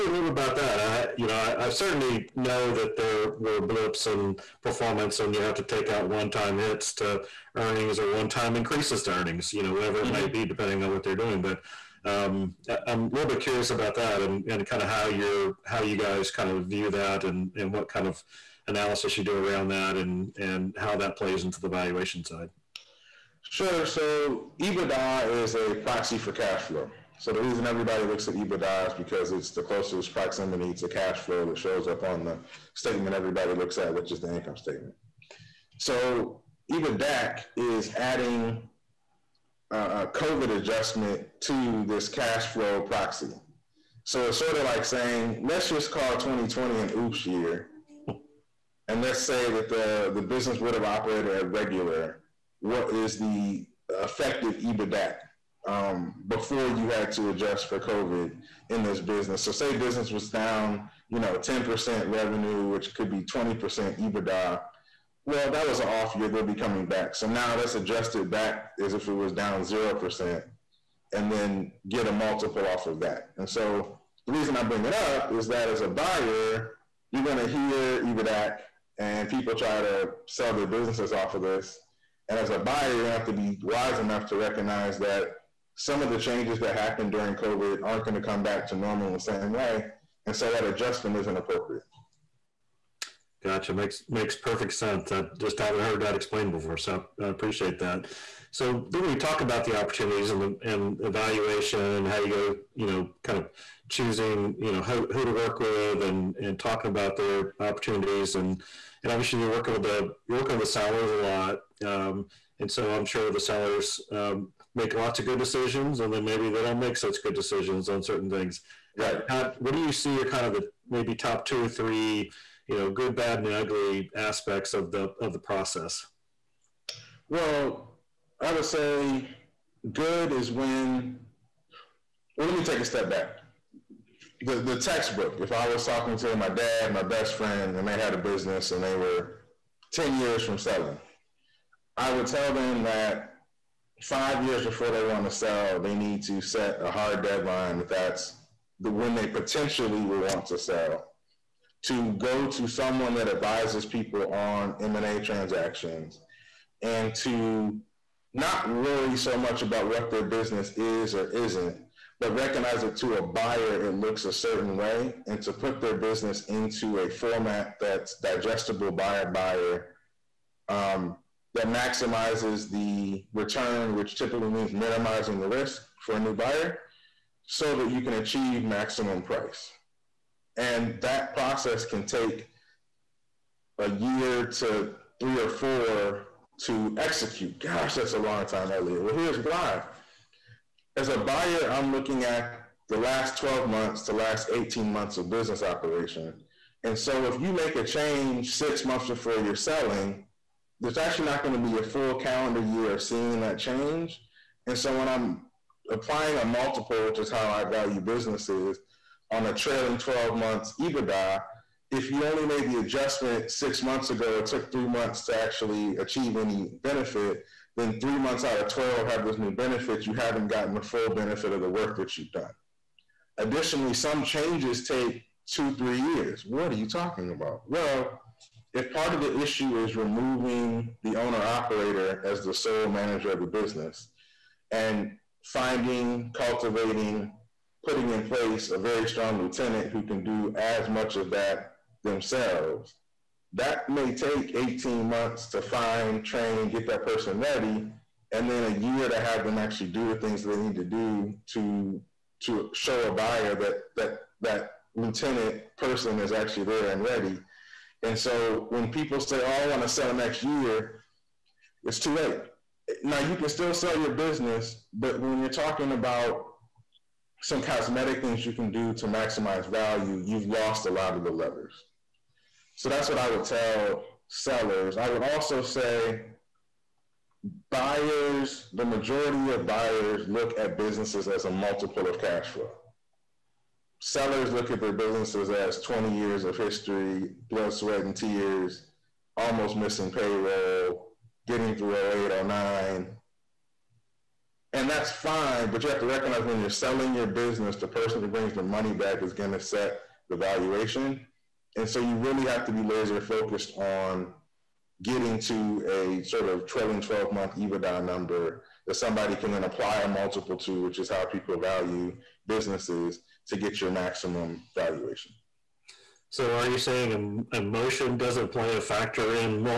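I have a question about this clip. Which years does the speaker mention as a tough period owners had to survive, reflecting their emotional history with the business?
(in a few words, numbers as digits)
2008 and 2009.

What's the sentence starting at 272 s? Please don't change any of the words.
So that's what I would tell sellers.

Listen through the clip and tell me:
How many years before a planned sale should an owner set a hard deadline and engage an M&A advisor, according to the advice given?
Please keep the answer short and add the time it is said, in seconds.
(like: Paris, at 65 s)
5 years, at 144 s.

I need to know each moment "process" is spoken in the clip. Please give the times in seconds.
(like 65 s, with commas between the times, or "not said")
125 s, 181 s.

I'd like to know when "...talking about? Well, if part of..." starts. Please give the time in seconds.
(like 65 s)
226 s.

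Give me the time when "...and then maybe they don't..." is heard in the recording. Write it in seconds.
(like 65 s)
116 s.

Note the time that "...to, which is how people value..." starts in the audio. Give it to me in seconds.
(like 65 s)
310 s.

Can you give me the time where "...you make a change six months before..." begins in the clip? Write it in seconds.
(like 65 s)
197 s.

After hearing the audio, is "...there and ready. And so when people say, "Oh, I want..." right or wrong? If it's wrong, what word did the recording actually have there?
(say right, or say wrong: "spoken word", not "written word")
right.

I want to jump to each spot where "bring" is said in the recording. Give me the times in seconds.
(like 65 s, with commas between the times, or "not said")
74 s, 298 s.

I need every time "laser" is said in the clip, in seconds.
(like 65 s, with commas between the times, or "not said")
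302 s.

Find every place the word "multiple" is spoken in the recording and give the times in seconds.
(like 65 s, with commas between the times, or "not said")
72 s, 206 s, 281 s, 310 s.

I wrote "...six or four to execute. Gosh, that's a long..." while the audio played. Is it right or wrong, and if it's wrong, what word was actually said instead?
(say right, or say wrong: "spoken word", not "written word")
wrong: "three", not "six".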